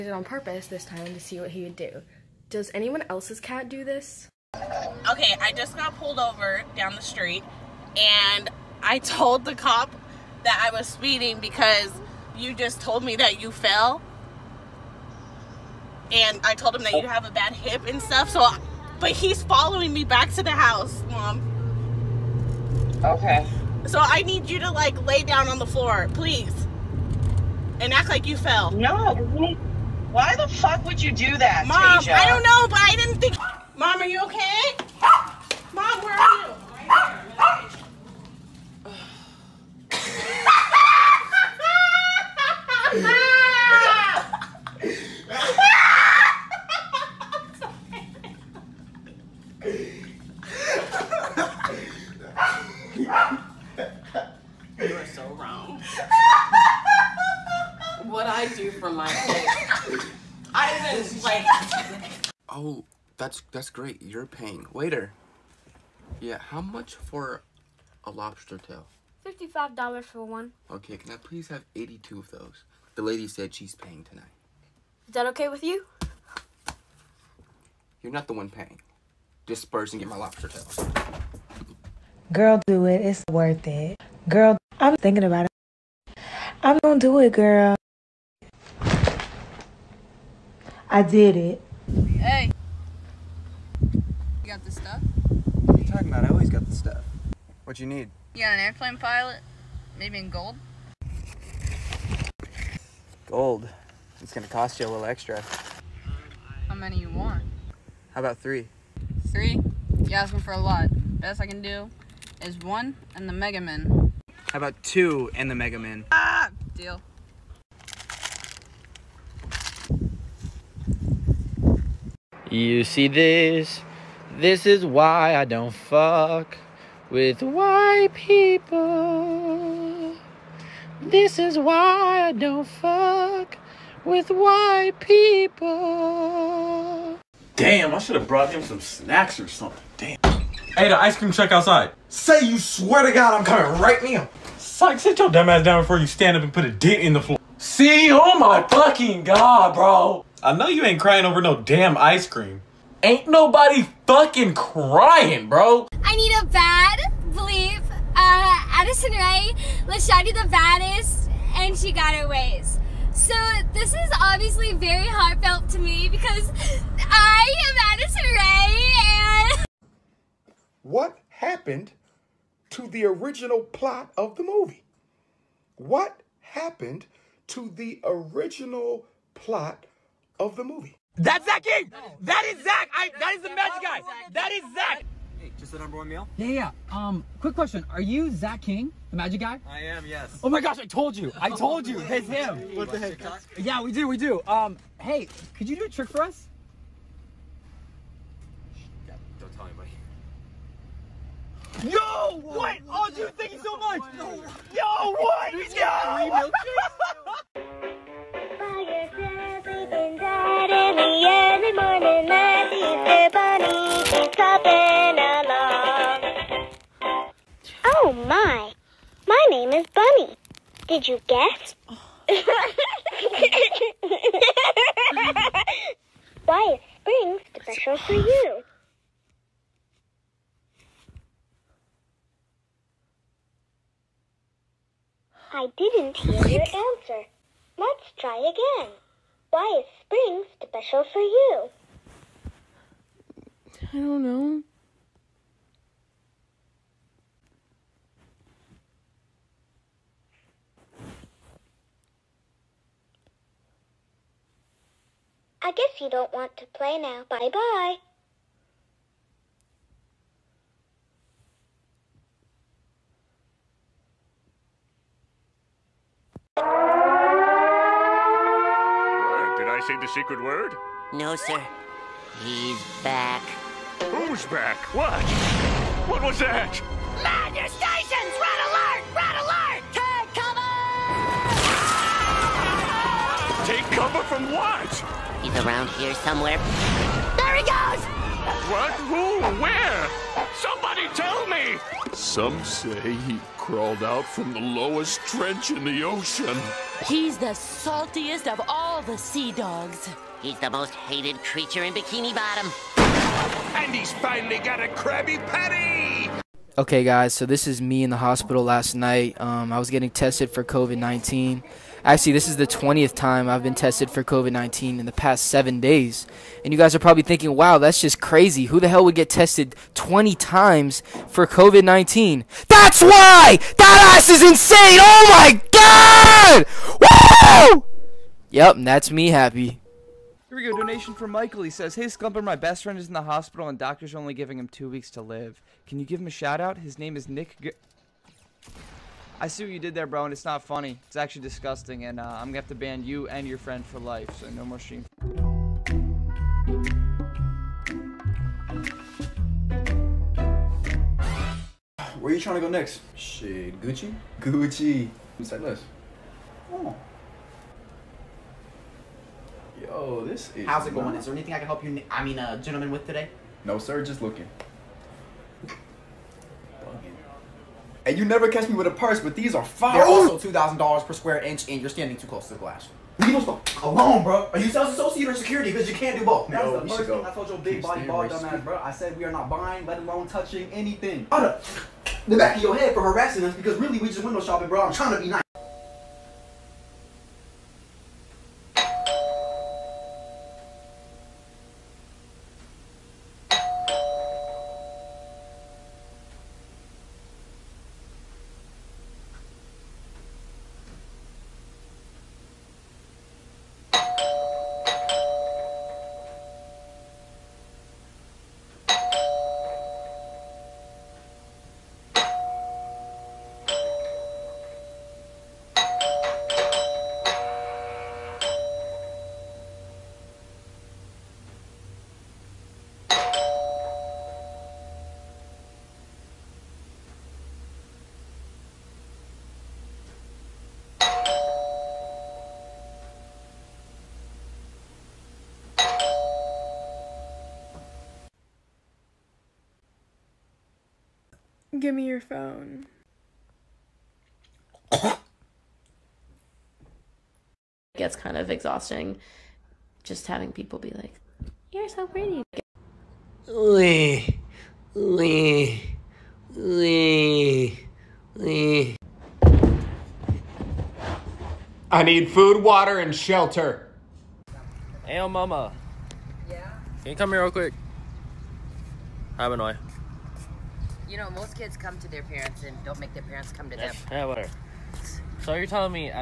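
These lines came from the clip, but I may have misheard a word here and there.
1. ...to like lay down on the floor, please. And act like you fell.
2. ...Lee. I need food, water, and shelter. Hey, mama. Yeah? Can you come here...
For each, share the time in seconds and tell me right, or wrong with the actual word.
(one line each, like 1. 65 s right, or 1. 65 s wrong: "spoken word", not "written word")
1. 24 s right
2. 458 s right.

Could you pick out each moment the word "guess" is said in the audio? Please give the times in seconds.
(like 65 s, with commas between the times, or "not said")
221 s, 255 s.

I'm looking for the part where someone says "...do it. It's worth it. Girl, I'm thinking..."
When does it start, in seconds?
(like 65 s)
82 s.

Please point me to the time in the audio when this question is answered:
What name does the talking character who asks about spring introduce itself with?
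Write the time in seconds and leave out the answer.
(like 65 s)
219 s.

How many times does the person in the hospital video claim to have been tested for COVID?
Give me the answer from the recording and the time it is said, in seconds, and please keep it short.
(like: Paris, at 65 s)
20, at 312 s.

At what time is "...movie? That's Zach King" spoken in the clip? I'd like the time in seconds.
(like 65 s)
180 s.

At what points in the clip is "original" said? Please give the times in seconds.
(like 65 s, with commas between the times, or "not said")
173 s, 178 s.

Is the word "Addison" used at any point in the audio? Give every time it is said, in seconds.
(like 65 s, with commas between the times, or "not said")
158 s, 167 s.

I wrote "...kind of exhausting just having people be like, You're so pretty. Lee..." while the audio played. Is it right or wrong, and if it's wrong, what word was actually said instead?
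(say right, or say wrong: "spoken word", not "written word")
right.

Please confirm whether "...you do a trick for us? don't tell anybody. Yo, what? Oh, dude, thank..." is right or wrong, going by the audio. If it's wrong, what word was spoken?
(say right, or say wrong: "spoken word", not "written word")
right.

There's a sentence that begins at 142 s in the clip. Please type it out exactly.
Say you swear to God I'm coming right now.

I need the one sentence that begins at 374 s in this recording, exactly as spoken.
Are you sales associate or security?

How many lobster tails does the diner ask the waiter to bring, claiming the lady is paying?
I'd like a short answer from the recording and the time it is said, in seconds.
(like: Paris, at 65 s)
82, at 71 s.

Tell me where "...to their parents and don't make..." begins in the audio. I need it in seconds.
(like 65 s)
471 s.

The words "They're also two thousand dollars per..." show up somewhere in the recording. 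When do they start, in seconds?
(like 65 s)
369 s.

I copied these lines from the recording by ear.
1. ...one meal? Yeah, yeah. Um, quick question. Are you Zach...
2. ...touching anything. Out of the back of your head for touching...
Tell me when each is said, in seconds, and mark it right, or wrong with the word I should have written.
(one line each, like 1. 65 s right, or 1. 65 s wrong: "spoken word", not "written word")
1. 185 s right
2. 380 s wrong: "harassing", not "touching".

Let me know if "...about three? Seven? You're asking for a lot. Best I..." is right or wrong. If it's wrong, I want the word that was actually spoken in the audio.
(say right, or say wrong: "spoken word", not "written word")
wrong: "Three", not "Seven".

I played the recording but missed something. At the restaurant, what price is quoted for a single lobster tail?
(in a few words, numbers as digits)
$55.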